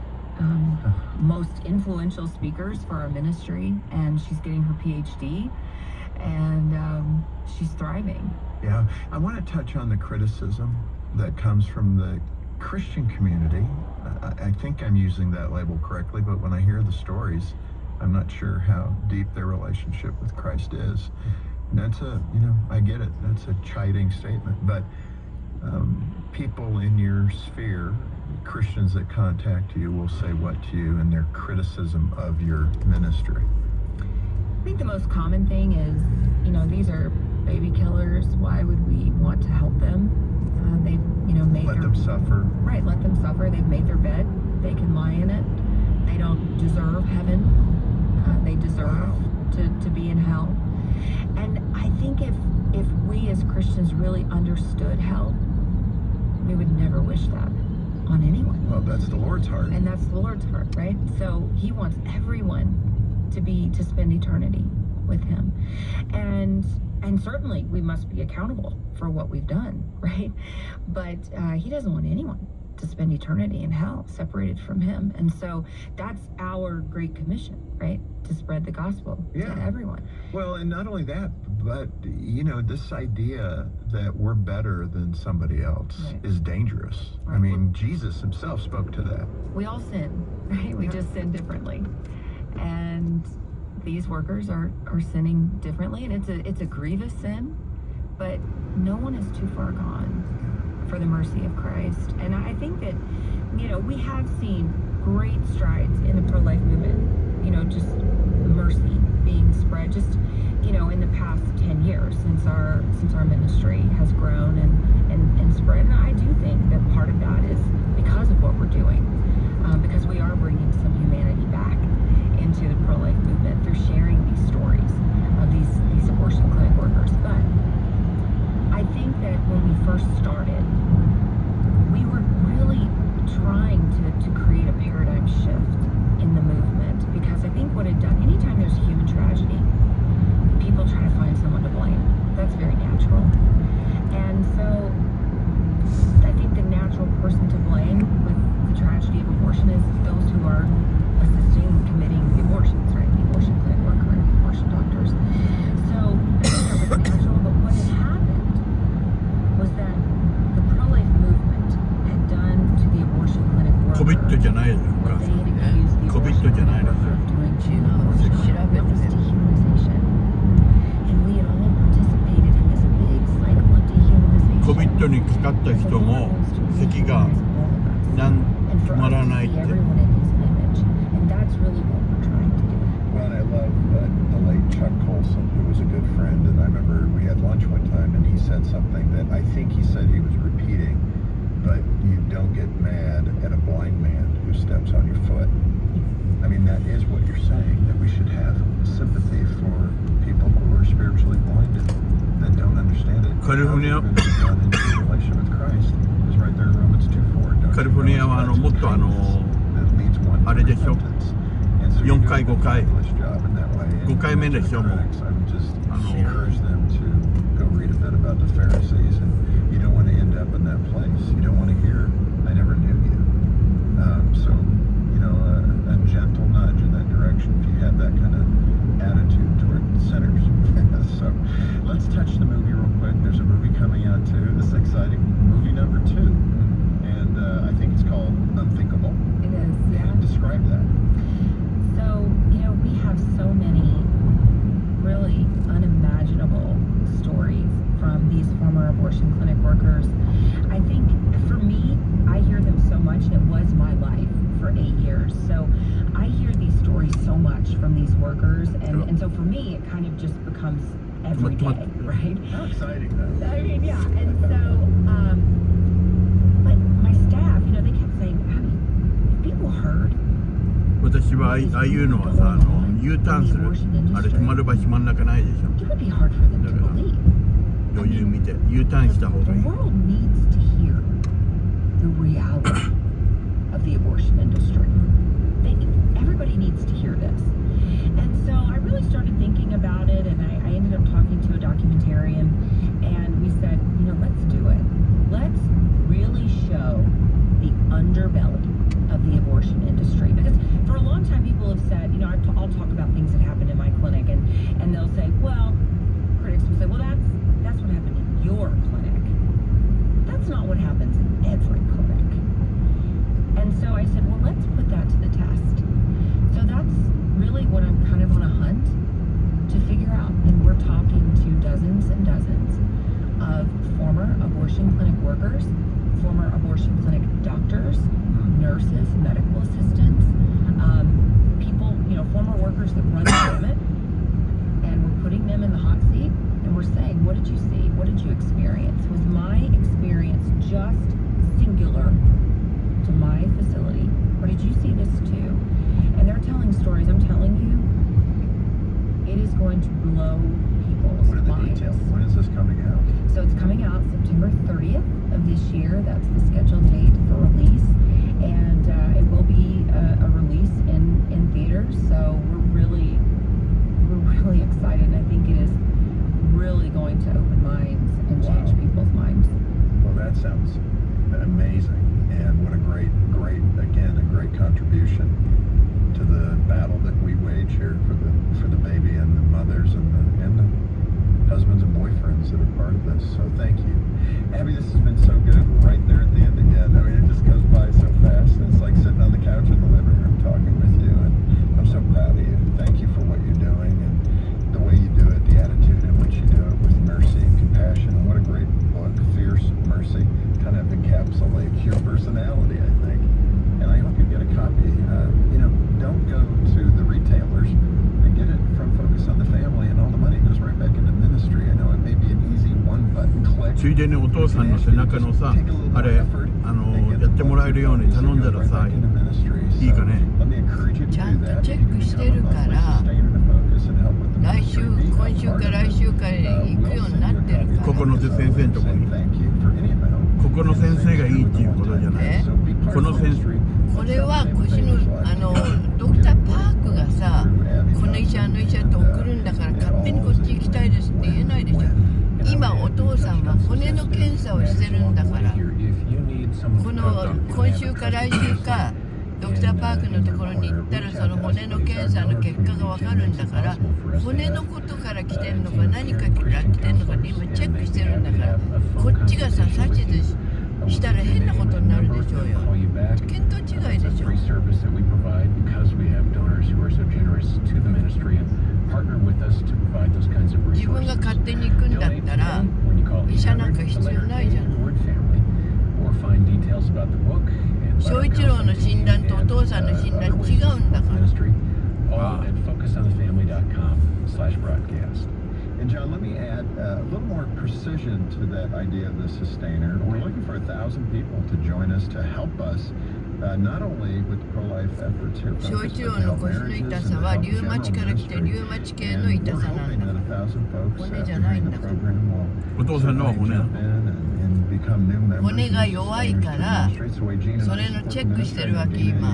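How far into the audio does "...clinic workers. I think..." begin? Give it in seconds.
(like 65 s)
249 s.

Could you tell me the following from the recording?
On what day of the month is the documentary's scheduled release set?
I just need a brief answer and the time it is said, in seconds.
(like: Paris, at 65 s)
30th, at 354 s.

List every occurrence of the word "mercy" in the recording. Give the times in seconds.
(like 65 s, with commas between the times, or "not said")
101 s, 108 s.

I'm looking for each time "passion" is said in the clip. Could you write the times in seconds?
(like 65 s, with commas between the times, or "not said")
not said.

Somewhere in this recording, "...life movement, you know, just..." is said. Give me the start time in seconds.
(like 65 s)
106 s.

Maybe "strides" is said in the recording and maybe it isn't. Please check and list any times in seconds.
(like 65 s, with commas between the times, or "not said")
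105 s.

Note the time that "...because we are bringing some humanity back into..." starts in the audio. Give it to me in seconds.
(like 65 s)
119 s.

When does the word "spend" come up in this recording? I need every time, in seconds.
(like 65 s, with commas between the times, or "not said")
63 s, 72 s.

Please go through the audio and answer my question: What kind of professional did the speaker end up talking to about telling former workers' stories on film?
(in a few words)
A documentarian.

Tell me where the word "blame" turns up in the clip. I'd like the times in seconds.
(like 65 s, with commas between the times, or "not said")
141 s, 147 s.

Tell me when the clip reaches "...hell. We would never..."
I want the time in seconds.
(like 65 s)
54 s.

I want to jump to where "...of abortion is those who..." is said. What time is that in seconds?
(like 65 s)
149 s.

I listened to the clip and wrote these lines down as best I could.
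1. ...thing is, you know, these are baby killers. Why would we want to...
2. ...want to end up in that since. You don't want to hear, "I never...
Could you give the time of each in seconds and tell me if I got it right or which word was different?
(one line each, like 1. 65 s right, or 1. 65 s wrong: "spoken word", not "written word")
1. 35 s right
2. 219 s wrong: "place", not "since".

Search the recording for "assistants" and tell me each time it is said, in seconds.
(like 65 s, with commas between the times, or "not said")
329 s.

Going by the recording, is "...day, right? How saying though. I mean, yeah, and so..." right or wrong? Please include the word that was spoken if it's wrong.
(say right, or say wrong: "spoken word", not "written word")
wrong: "exciting", not "saying".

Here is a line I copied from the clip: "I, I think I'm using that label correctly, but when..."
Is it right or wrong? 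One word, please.
right.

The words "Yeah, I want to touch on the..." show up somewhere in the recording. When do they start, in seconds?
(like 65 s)
8 s.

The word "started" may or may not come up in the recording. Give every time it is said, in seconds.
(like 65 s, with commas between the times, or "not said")
130 s, 289 s.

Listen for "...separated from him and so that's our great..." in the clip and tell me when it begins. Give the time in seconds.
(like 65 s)
74 s.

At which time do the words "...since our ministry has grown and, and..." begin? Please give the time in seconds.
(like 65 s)
112 s.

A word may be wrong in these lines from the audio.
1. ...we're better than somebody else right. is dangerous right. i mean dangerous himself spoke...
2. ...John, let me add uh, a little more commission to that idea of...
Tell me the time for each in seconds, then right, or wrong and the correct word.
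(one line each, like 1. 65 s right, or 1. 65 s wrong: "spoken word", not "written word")
1. 84 s wrong: "jesus", not "dangerous"
2. 485 s wrong: "precision", not "commission".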